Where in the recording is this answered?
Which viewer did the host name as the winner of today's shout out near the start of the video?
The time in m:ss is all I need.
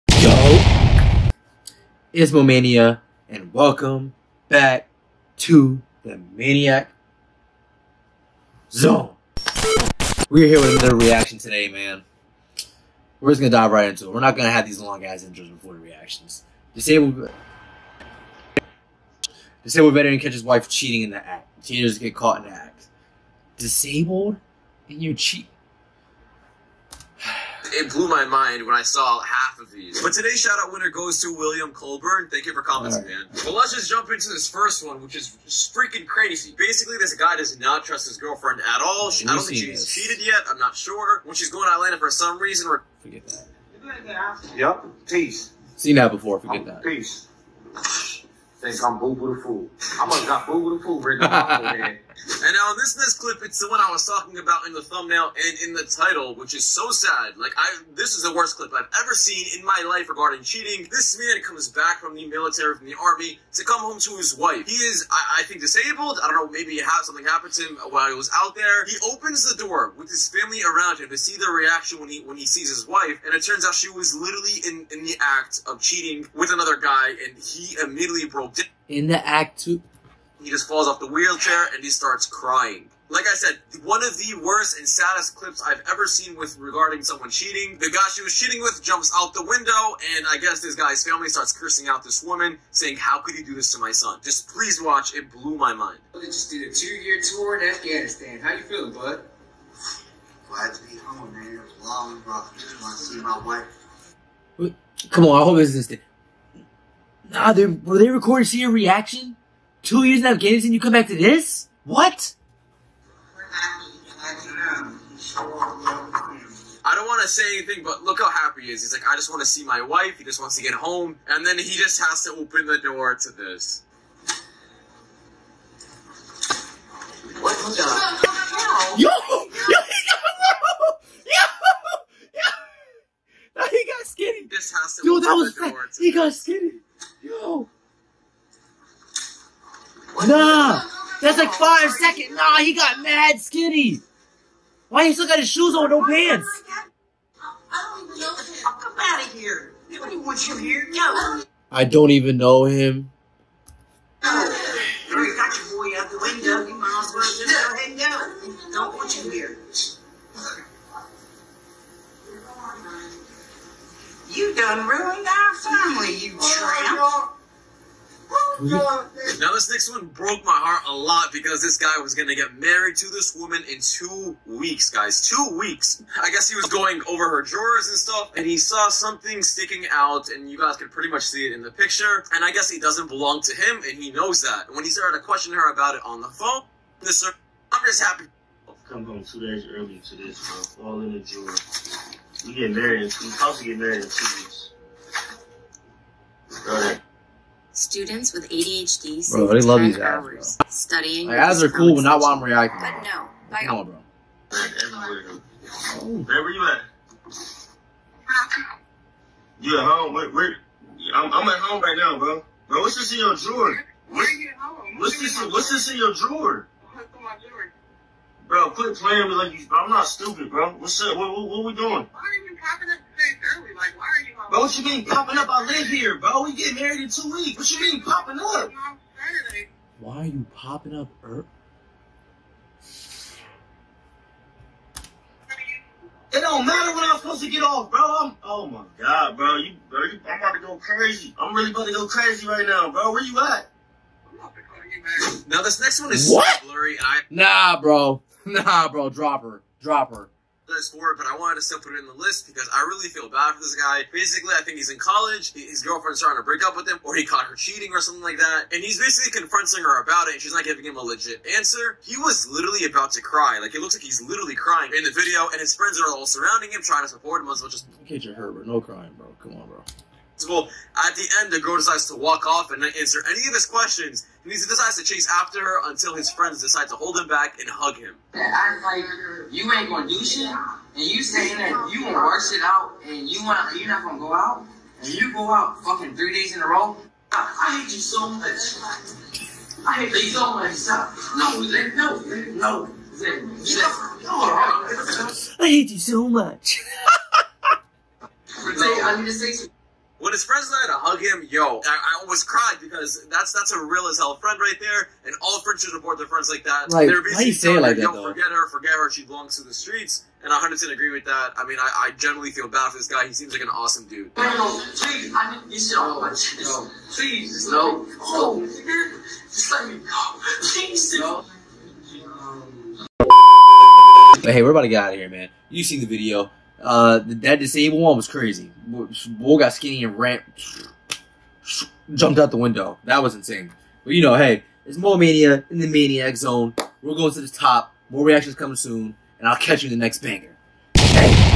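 0:31.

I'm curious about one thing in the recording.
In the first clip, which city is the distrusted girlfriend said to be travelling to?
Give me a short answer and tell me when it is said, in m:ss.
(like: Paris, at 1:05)
Atlanta, at 0:41.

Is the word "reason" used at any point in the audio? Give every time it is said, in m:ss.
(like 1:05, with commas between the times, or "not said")
0:42.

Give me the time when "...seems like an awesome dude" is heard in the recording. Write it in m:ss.
5:13.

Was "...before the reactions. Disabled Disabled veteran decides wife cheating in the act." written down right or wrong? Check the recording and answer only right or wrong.
wrong.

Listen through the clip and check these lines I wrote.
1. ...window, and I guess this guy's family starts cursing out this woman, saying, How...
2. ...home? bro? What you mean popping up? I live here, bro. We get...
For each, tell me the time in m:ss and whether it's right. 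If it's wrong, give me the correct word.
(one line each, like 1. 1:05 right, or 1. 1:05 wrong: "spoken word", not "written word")
1. 1:29 right
2. 3:44 right.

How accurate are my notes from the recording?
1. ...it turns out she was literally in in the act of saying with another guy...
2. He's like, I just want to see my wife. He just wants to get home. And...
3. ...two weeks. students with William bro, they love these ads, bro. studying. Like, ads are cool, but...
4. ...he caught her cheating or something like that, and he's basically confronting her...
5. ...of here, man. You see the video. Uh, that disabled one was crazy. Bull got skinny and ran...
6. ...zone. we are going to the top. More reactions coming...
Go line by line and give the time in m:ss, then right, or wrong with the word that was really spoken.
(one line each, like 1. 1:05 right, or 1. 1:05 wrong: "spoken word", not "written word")
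1. 1:13 wrong: "cheating", not "saying"
2. 1:58 right
3. 3:14 wrong: "ADHD", not "William"
4. 4:17 right
5. 5:25 right
6. 5:36 right.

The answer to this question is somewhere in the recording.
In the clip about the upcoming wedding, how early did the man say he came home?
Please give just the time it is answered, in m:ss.
3:09.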